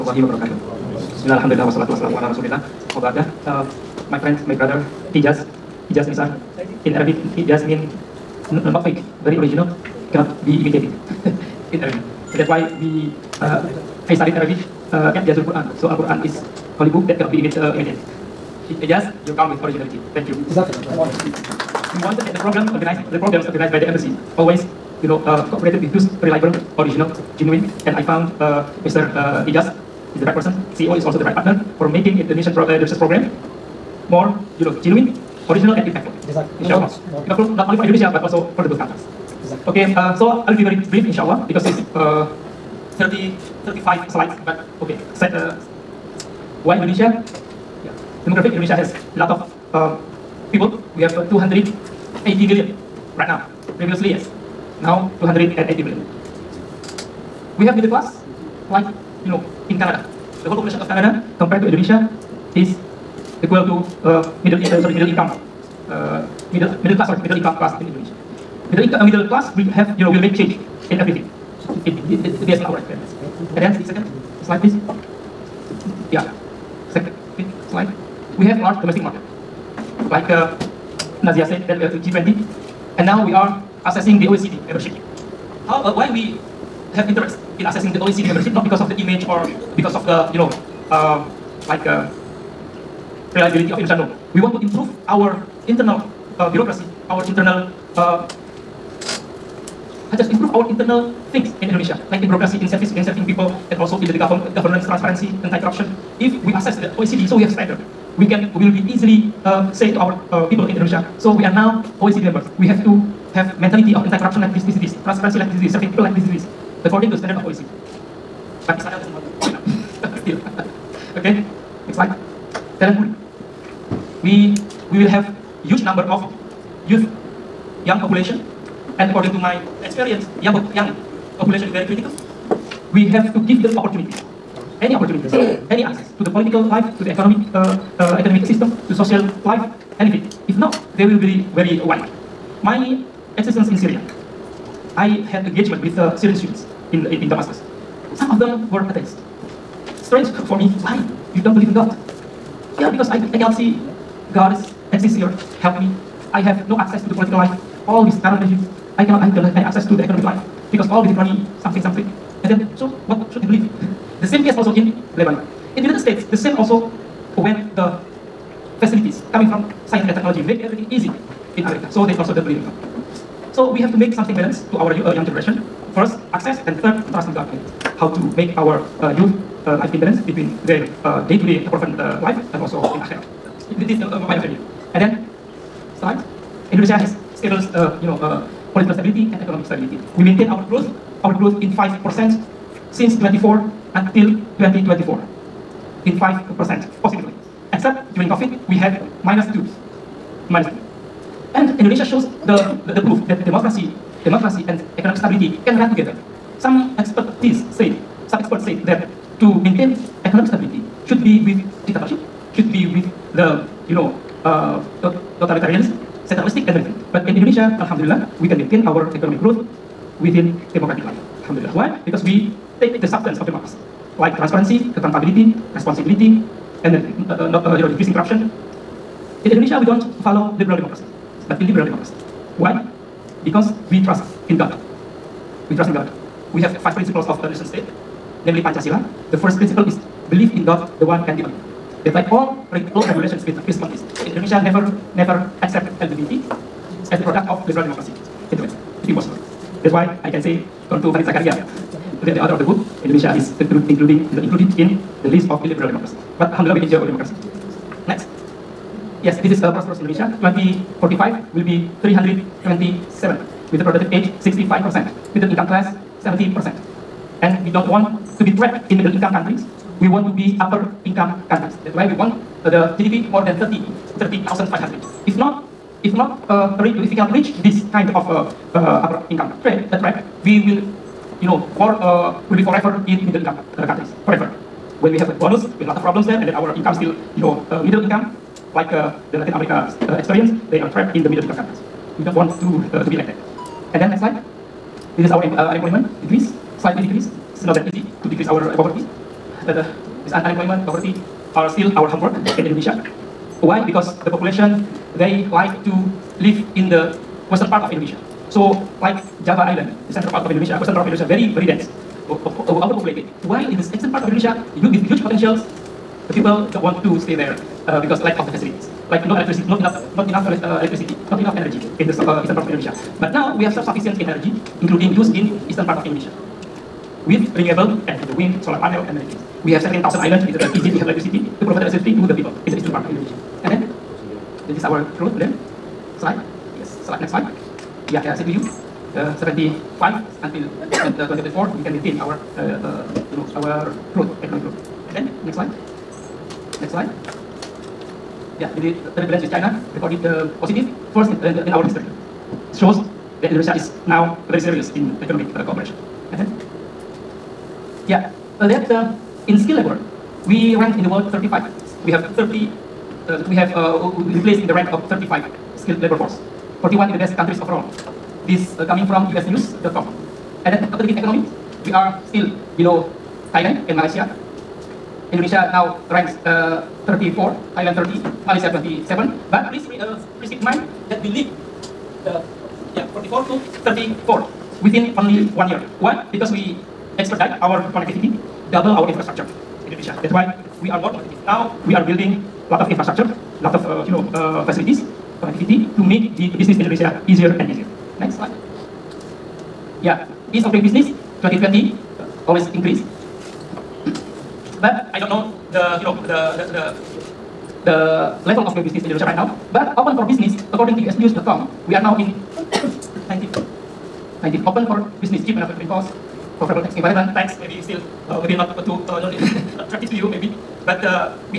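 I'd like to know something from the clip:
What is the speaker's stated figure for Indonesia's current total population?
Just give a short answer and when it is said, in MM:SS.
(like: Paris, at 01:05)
280 million, at 00:51.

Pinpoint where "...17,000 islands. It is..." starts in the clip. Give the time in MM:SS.
05:29.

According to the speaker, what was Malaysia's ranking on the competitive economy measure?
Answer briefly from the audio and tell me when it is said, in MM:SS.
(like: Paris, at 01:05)
27, at 06:18.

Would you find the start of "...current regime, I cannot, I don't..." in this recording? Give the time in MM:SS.
02:38.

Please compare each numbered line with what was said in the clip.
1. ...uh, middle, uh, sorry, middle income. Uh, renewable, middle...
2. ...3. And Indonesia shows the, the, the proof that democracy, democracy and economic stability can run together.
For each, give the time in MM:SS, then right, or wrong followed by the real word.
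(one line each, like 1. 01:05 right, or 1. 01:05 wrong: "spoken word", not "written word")
1. 01:04 wrong: "middle", not "renewable"
2. 03:20 wrong: "2", not "3".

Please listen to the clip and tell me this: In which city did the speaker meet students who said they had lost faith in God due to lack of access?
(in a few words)
Damascus.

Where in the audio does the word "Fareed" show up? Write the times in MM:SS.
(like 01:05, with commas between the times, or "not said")
04:11.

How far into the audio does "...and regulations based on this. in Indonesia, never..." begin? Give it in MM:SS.
04:03.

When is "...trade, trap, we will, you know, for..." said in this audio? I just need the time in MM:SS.
04:39.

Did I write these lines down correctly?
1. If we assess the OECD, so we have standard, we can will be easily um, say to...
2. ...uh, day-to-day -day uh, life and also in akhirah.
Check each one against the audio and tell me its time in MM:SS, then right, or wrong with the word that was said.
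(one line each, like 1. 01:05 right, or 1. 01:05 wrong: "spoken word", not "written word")
1. 01:46 right
2. 03:01 right.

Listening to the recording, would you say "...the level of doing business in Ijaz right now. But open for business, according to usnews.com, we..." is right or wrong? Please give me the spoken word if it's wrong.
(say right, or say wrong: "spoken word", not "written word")
wrong: "Indonesia", not "Ijaz".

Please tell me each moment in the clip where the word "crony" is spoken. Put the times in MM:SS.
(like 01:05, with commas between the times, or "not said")
02:41.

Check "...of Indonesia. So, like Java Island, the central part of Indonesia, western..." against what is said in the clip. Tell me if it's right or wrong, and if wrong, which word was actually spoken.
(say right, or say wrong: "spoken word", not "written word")
right.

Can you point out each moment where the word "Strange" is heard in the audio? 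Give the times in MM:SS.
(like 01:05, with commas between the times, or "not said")
02:30.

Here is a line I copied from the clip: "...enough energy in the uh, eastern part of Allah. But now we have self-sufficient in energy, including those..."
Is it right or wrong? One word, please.
wrong.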